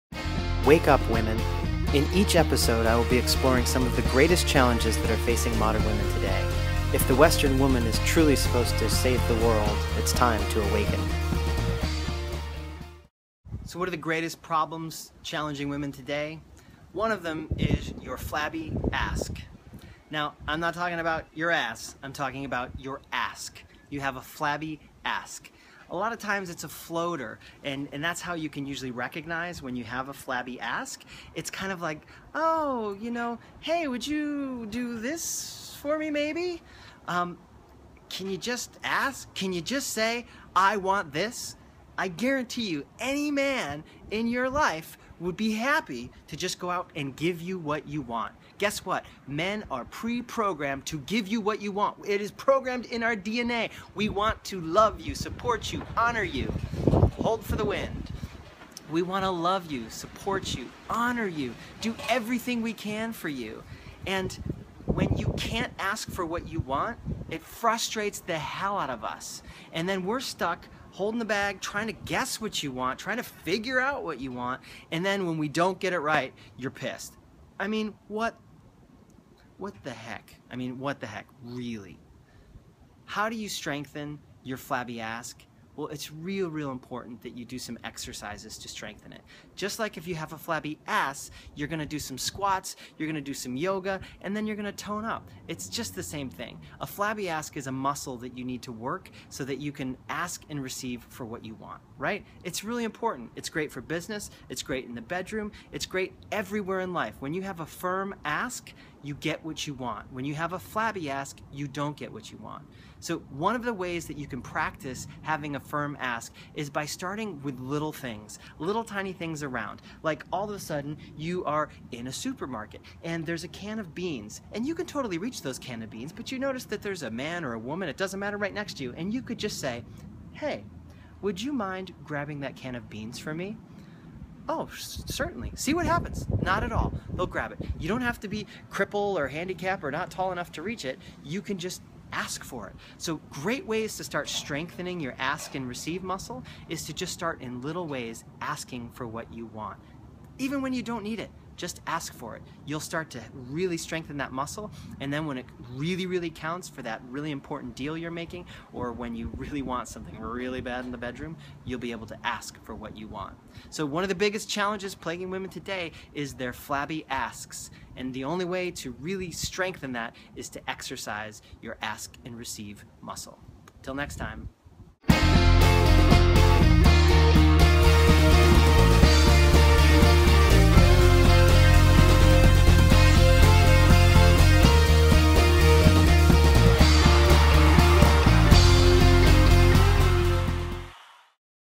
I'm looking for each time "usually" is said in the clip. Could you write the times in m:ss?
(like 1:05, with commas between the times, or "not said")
0:28.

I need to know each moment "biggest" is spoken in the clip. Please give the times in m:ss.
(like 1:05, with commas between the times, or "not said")
2:44.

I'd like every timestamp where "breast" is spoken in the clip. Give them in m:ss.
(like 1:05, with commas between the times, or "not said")
not said.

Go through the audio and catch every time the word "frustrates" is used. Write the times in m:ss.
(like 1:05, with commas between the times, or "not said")
1:07.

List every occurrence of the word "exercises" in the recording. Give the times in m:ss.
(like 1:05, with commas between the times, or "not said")
1:27, 2:50.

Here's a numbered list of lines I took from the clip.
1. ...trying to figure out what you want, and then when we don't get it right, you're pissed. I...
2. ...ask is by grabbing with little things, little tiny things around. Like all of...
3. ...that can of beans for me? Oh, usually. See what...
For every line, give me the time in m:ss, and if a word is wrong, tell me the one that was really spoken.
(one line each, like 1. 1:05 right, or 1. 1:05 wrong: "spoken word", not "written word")
1. 1:12 right
2. 1:55 wrong: "starting", not "grabbing"
3. 2:12 wrong: "certainly", not "usually".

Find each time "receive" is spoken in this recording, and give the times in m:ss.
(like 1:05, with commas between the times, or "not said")
1:40, 2:25, 2:52.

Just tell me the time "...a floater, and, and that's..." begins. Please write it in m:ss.
0:26.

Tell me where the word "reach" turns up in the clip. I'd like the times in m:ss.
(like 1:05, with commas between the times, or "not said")
2:05, 2:20.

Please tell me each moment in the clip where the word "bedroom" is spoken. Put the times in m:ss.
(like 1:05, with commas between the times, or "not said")
1:45, 2:40.